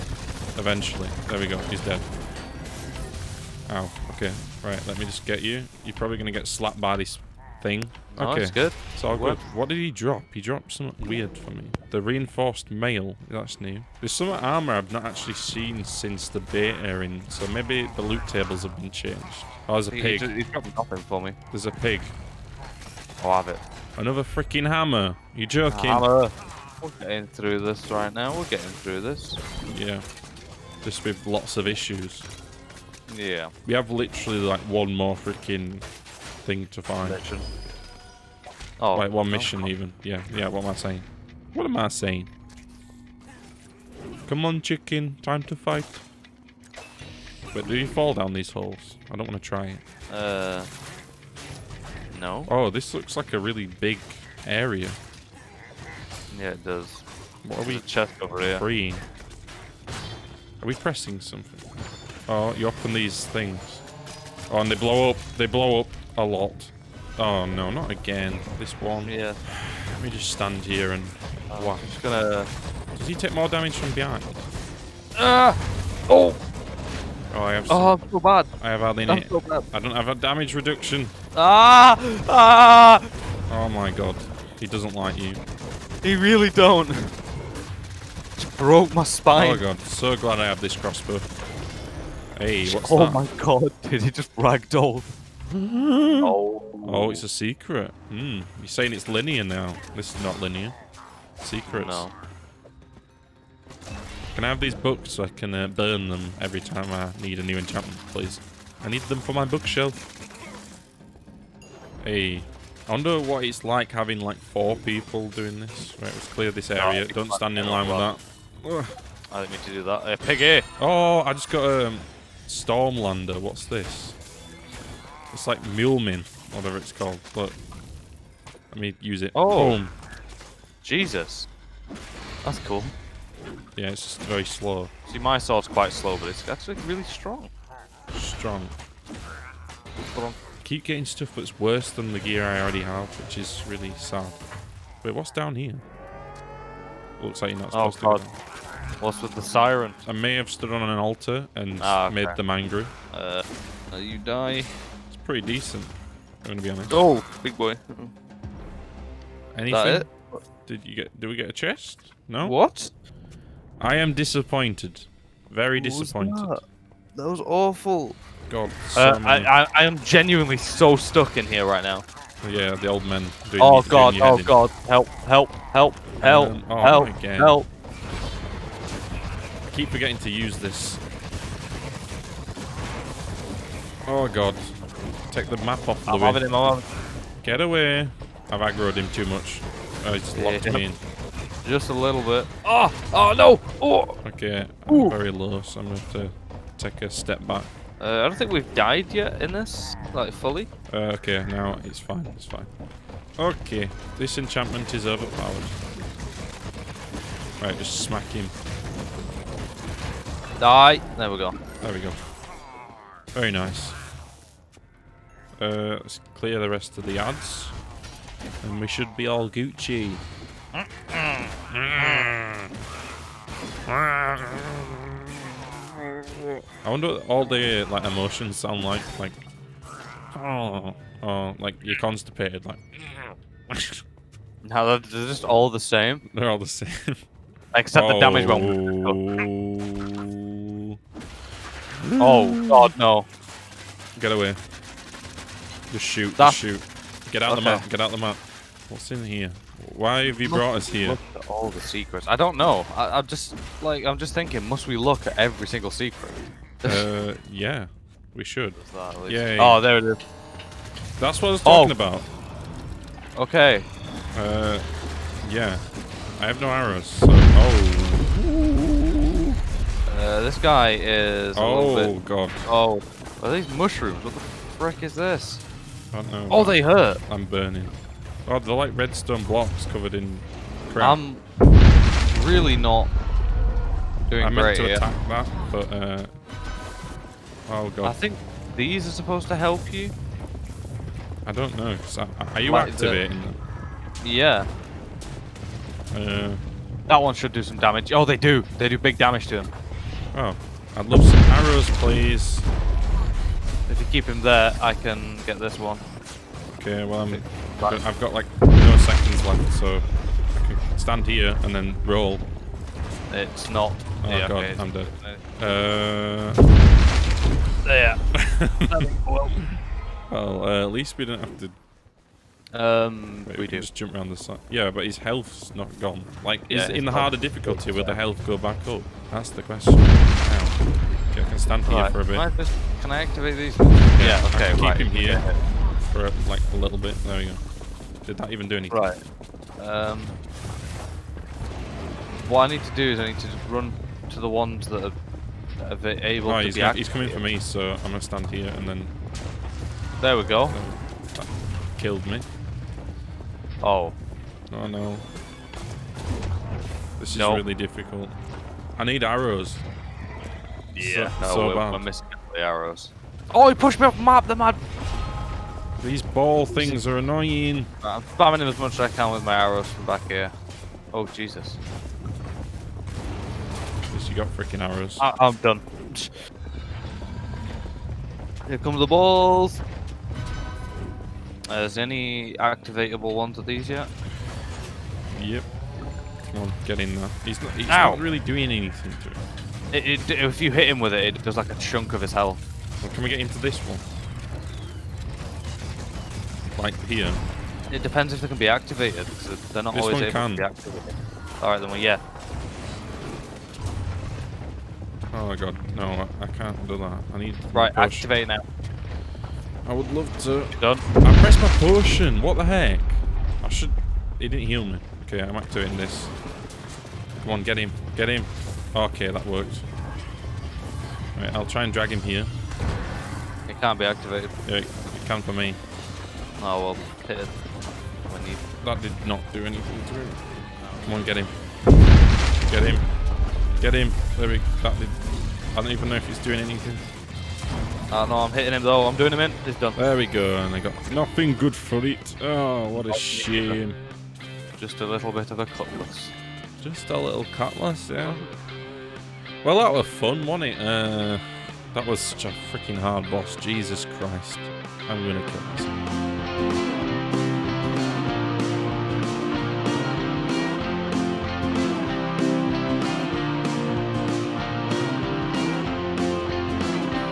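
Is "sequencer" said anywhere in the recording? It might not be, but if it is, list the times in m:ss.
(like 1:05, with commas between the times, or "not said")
not said.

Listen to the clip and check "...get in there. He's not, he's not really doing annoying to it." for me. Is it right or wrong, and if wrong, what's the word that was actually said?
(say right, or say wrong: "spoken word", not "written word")
wrong: "anything", not "annoying".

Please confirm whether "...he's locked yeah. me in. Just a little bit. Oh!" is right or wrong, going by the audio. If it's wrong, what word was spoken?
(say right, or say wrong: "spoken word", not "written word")
right.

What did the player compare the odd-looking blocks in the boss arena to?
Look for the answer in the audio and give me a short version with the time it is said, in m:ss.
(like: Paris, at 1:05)
Redstone blocks, at 4:38.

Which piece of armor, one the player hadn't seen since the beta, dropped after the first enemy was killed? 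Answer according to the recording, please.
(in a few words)
Reinforced mail.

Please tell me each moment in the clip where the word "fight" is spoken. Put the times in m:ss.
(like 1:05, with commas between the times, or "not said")
0:45.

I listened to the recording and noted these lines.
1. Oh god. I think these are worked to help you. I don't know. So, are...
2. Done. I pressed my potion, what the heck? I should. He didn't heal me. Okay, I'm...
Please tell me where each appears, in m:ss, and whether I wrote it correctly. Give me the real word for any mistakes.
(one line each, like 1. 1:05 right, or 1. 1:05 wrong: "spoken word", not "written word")
1. 4:47 wrong: "supposed", not "worked"
2. 6:50 right.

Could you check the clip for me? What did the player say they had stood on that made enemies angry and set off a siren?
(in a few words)
An altar.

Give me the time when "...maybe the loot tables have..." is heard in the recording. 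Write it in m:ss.
0:17.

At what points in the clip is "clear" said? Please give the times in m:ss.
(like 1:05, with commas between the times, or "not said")
1:56, 3:36.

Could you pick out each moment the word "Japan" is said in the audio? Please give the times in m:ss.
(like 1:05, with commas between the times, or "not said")
not said.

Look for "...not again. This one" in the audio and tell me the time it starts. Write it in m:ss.
1:07.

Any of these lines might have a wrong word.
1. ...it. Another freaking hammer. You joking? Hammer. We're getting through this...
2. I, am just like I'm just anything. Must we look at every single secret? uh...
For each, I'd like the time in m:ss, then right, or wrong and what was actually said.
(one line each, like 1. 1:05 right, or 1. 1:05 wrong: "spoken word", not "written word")
1. 0:23 right
2. 4:12 wrong: "thinking", not "anything".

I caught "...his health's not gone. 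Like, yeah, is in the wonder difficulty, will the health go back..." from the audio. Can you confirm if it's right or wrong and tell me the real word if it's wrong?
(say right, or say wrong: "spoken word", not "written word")
wrong: "harder", not "wonder".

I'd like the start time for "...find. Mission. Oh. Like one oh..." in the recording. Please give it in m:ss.
0:36.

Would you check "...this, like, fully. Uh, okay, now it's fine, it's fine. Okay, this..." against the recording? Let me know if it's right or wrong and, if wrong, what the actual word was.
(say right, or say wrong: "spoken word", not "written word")
right.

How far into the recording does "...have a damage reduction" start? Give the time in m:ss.
1:19.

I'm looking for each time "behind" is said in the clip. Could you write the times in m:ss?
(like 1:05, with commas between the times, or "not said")
1:13.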